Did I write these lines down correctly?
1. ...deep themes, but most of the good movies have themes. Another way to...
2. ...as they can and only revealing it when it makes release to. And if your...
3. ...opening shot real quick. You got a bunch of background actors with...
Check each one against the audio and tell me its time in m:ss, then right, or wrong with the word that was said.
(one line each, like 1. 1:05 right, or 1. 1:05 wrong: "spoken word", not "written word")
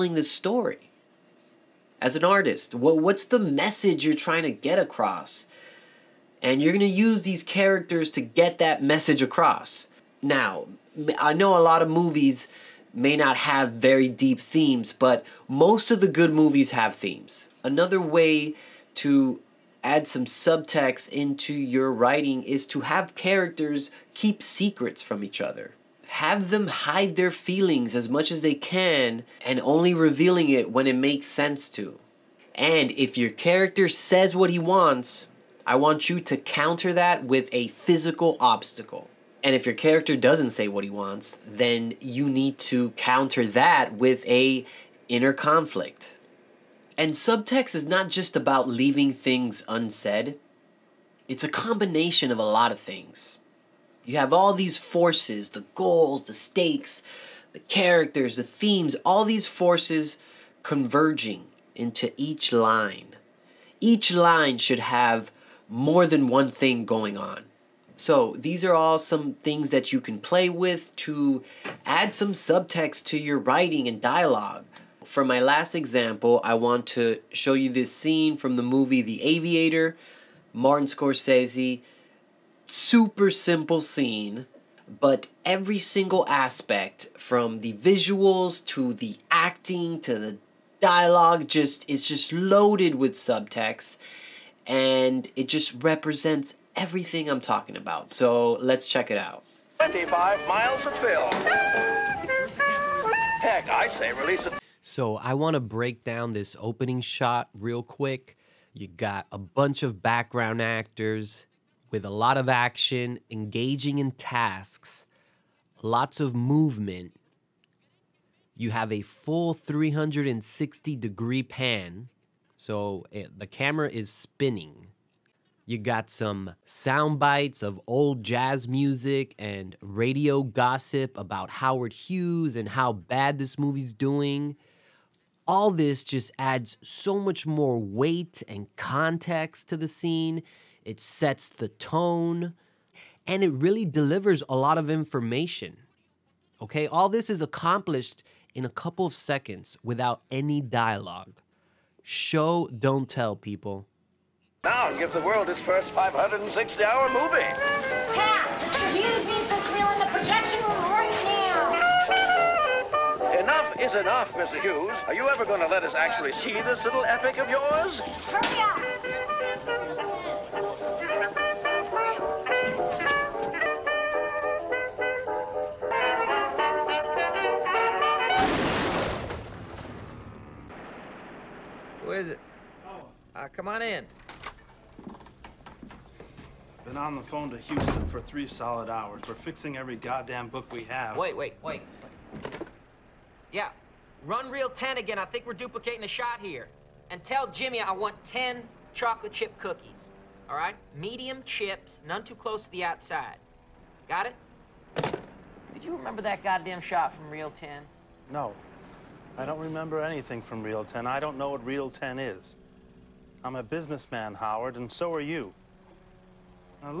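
1. 0:14 right
2. 0:28 wrong: "sense", not "release"
3. 1:46 right.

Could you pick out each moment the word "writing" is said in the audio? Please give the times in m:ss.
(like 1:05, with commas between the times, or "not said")
0:21, 1:13.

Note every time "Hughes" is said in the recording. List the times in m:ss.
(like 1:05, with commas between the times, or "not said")
2:11, 2:44.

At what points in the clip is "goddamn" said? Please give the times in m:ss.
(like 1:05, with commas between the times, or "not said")
3:09, 3:26.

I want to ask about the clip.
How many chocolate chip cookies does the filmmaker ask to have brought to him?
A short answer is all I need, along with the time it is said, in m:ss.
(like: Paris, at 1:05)
10, at 3:18.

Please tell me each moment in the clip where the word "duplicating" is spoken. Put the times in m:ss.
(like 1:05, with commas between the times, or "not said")
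3:15.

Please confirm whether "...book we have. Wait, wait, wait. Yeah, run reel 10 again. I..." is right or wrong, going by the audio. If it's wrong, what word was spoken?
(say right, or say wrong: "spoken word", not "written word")
right.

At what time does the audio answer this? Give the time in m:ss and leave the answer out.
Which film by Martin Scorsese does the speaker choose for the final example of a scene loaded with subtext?
1:19.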